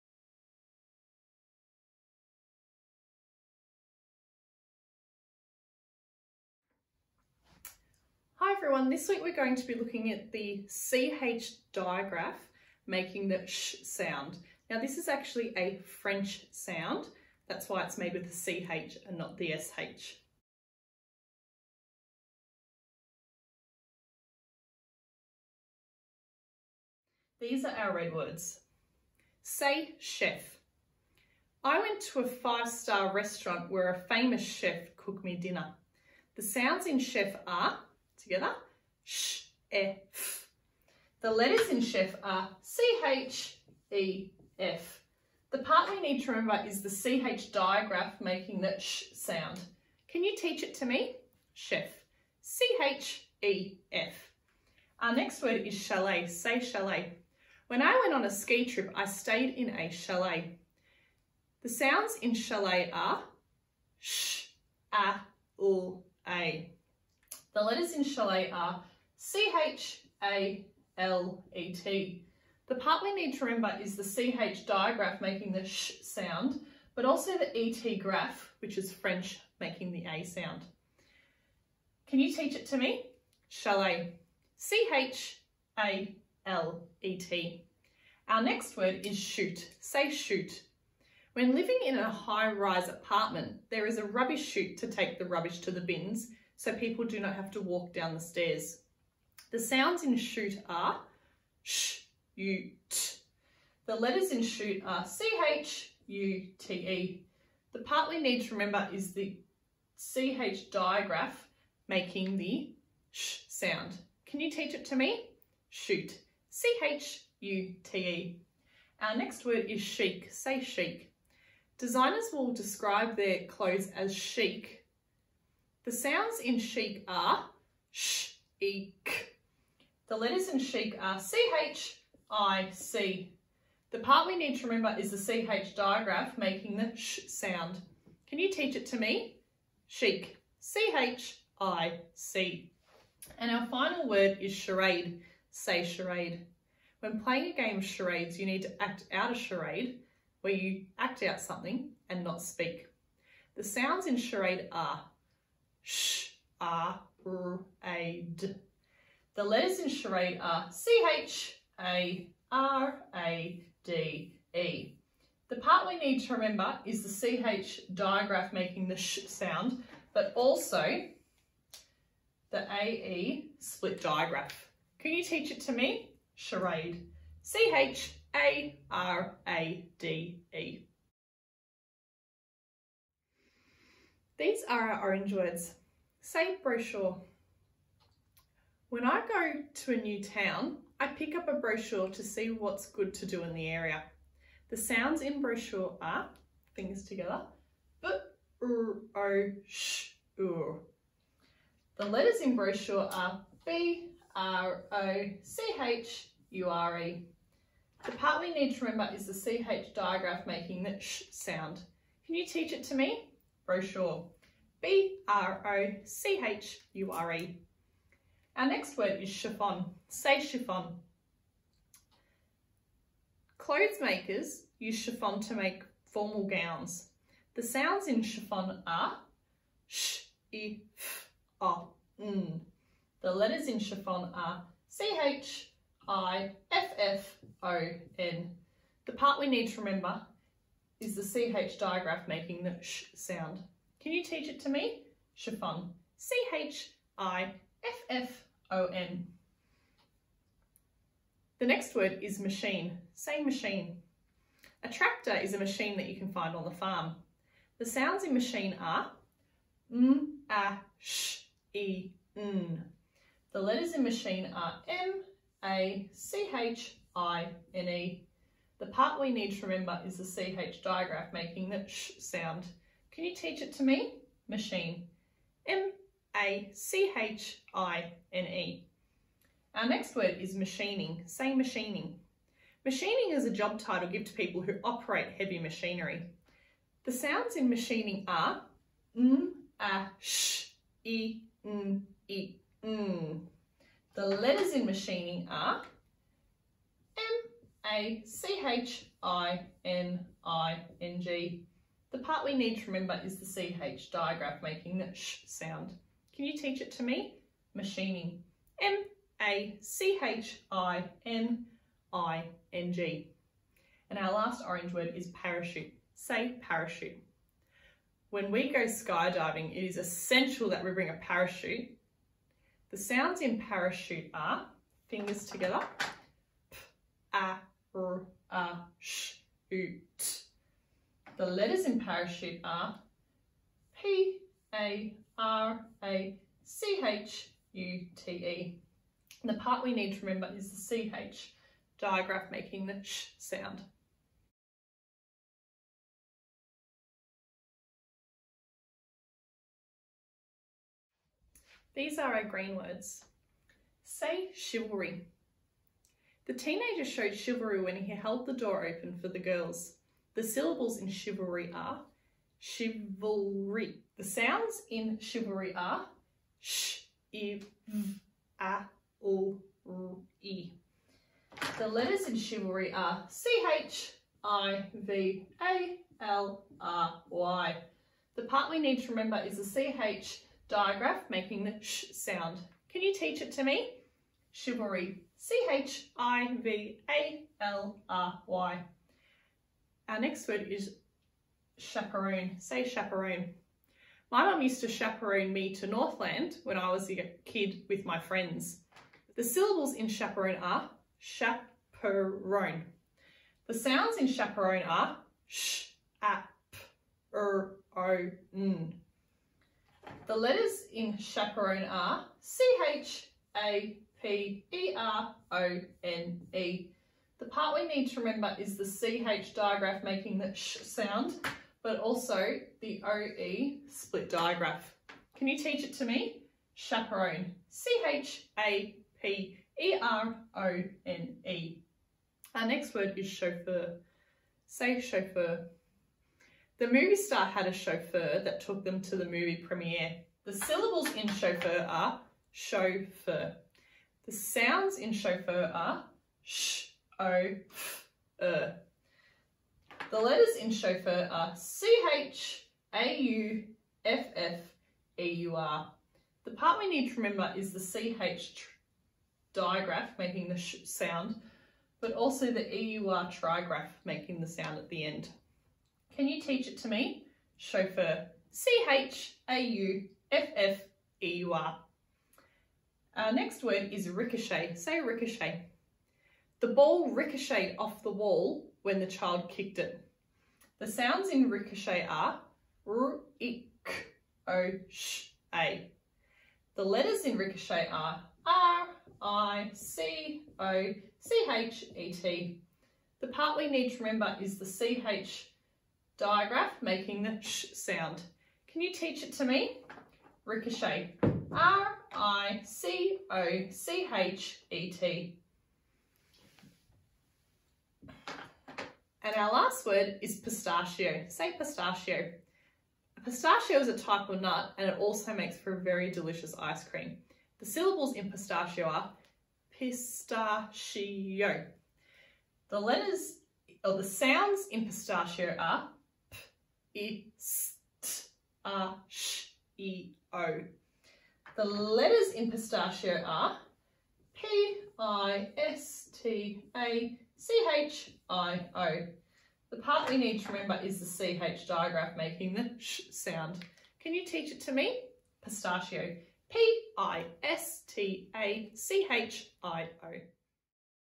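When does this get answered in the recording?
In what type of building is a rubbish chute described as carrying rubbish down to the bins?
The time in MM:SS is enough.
01:32.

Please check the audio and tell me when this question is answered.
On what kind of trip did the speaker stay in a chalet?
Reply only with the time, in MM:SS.
00:58.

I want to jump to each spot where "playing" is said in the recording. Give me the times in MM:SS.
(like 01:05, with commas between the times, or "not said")
02:27.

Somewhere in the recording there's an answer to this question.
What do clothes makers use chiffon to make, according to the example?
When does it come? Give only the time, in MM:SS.
03:46.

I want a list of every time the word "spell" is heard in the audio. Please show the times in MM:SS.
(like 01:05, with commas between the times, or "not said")
not said.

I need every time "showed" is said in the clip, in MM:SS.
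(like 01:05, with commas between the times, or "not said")
05:57.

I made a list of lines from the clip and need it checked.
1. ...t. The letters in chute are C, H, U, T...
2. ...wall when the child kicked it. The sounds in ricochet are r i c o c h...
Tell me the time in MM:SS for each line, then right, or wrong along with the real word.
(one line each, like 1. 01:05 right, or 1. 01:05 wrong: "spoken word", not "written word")
1. 01:42 right
2. 07:58 right.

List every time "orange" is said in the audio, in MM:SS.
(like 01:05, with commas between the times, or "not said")
03:05, 05:14.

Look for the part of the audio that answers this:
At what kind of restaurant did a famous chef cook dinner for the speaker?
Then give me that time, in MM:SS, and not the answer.
00:32.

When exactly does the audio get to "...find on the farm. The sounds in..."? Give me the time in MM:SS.
04:16.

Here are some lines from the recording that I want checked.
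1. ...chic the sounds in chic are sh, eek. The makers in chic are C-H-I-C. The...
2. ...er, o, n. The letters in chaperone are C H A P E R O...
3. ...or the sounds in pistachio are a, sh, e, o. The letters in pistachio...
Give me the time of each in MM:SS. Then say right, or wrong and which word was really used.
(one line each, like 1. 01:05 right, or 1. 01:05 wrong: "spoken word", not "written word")
1. 02:04 wrong: "letters", not "makers"
2. 06:47 right
3. 08:43 right.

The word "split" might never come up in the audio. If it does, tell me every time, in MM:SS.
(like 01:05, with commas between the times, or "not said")
02:53, 07:03.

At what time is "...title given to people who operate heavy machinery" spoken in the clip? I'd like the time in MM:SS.
04:43.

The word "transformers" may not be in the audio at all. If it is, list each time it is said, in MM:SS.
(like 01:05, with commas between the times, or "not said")
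not said.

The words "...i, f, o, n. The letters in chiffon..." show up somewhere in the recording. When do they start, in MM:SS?
03:50.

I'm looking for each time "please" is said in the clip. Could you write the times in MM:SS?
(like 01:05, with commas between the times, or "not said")
not said.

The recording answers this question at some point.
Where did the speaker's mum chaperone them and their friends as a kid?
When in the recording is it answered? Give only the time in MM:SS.
06:35.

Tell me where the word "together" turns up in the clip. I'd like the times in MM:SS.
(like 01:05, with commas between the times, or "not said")
00:38, 03:17, 05:25.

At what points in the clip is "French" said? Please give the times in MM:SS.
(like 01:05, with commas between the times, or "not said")
00:16, 01:18.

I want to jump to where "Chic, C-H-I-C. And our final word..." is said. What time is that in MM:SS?
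02:19.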